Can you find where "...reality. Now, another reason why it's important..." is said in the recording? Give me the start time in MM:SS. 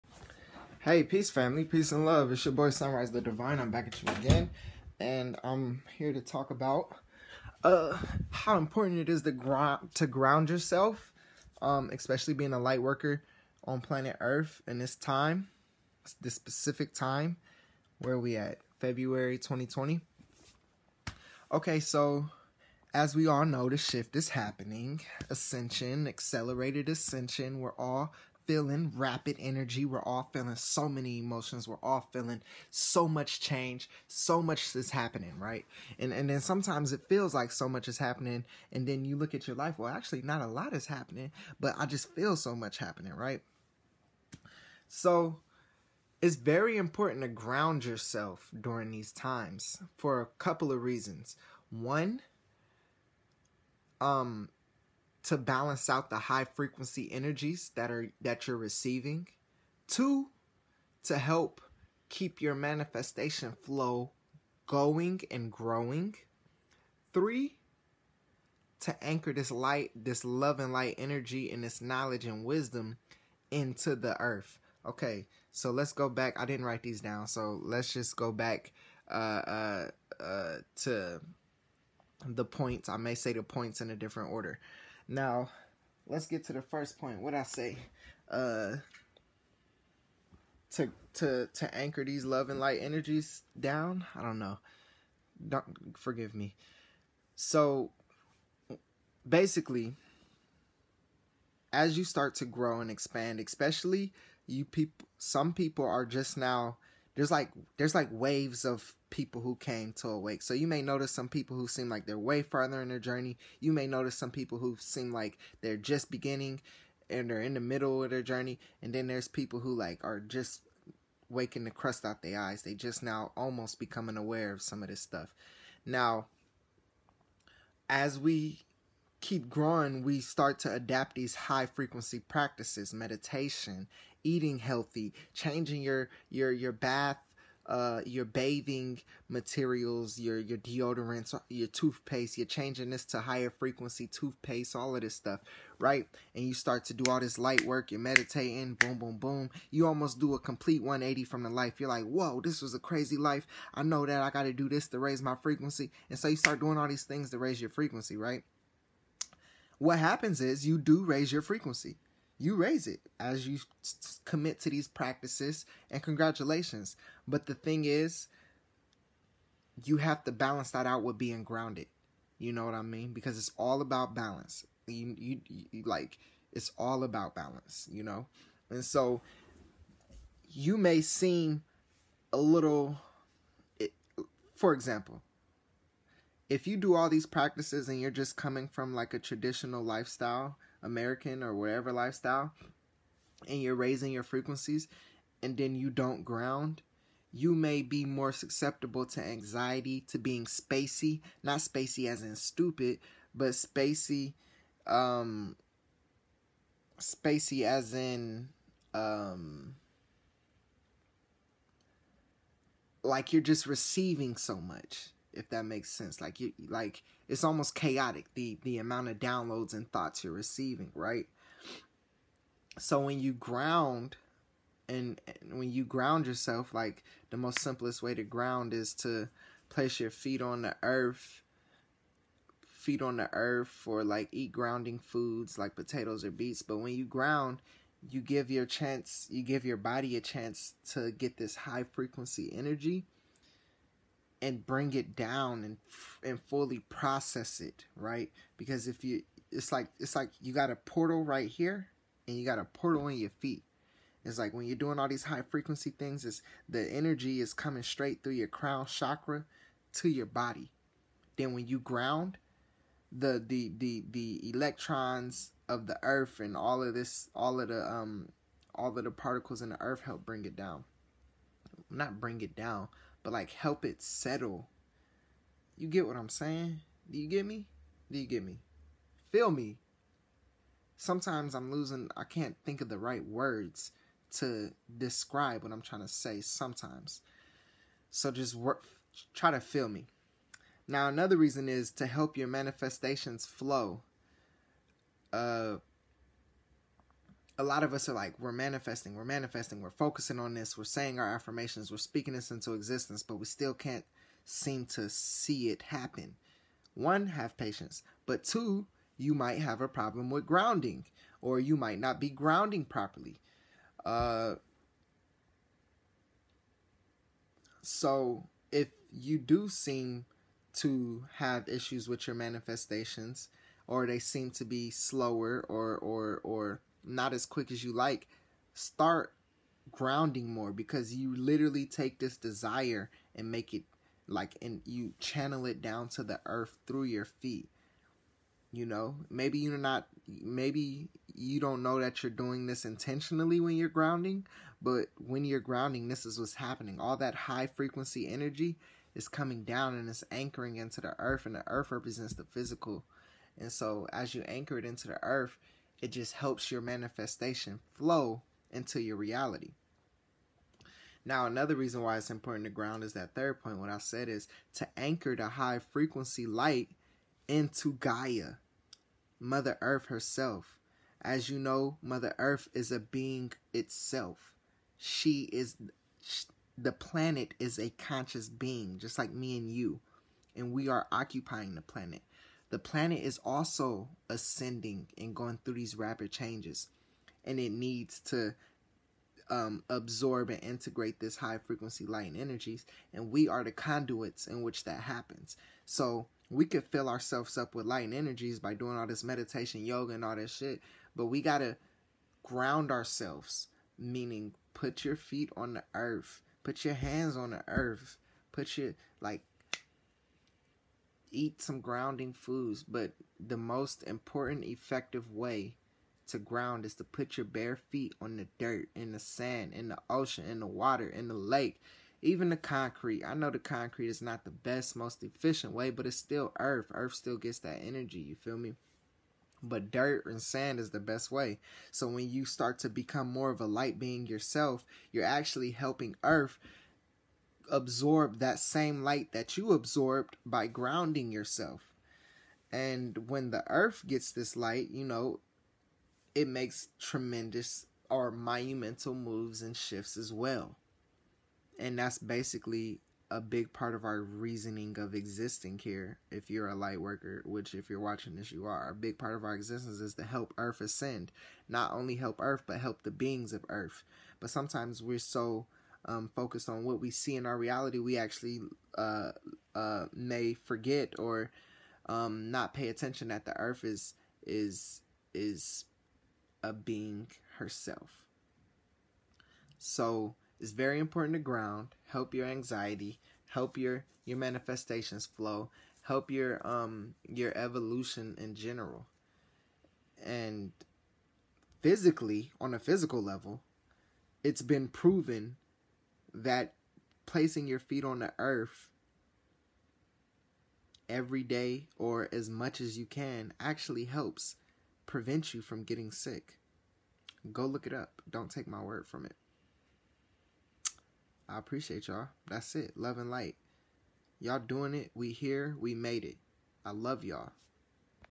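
05:59.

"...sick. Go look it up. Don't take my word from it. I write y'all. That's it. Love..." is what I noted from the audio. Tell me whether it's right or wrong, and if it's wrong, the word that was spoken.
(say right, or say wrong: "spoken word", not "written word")
wrong: "appreciate", not "write".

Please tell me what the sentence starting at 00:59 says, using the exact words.
Two, to help keep your manifestation flow going and growing.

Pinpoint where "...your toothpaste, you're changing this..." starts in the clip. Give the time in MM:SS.
02:21.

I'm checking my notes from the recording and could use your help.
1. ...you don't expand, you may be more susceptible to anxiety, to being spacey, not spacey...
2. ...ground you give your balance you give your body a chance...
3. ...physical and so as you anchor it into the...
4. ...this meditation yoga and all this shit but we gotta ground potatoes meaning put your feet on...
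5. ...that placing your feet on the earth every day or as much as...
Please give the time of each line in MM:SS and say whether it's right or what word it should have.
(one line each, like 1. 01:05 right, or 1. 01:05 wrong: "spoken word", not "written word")
1. 03:15 wrong: "ground", not "expand"
2. 03:57 wrong: "chance", not "balance"
3. 05:52 right
4. 06:39 wrong: "ourselves", not "potatoes"
5. 08:16 right.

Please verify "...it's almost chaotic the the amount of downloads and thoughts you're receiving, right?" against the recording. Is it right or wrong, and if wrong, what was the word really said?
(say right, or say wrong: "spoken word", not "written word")
right.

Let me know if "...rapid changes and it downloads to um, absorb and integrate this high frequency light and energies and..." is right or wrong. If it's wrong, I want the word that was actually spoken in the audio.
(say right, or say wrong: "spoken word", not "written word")
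wrong: "needs", not "downloads".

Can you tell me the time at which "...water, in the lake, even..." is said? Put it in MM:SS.
07:00.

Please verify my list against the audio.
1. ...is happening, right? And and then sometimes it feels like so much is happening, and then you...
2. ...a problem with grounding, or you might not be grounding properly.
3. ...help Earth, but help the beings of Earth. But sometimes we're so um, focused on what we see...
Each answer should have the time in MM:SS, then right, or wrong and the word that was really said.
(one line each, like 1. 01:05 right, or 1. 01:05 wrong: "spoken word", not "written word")
1. 00:34 right
2. 05:09 right
3. 07:42 right.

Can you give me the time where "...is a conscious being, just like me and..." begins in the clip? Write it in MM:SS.
06:17.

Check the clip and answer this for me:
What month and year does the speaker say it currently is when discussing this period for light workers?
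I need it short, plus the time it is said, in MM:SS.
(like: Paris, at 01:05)
February 2020, at 00:18.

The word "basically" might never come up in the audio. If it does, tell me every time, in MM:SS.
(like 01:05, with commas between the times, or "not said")
01:39, 07:32.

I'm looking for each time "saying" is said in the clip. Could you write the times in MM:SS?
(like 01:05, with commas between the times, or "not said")
04:36, 05:00.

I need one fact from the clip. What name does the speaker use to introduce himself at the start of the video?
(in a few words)
Sunrise the Divine.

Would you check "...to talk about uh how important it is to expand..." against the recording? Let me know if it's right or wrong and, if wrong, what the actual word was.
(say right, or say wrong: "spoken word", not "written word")
wrong: "ground", not "expand".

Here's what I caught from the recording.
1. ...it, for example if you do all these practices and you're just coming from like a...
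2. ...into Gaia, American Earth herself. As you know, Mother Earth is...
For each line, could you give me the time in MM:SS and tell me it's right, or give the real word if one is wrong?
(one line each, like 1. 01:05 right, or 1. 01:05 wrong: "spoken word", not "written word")
1. 03:03 right
2. 06:07 wrong: "Mother", not "American".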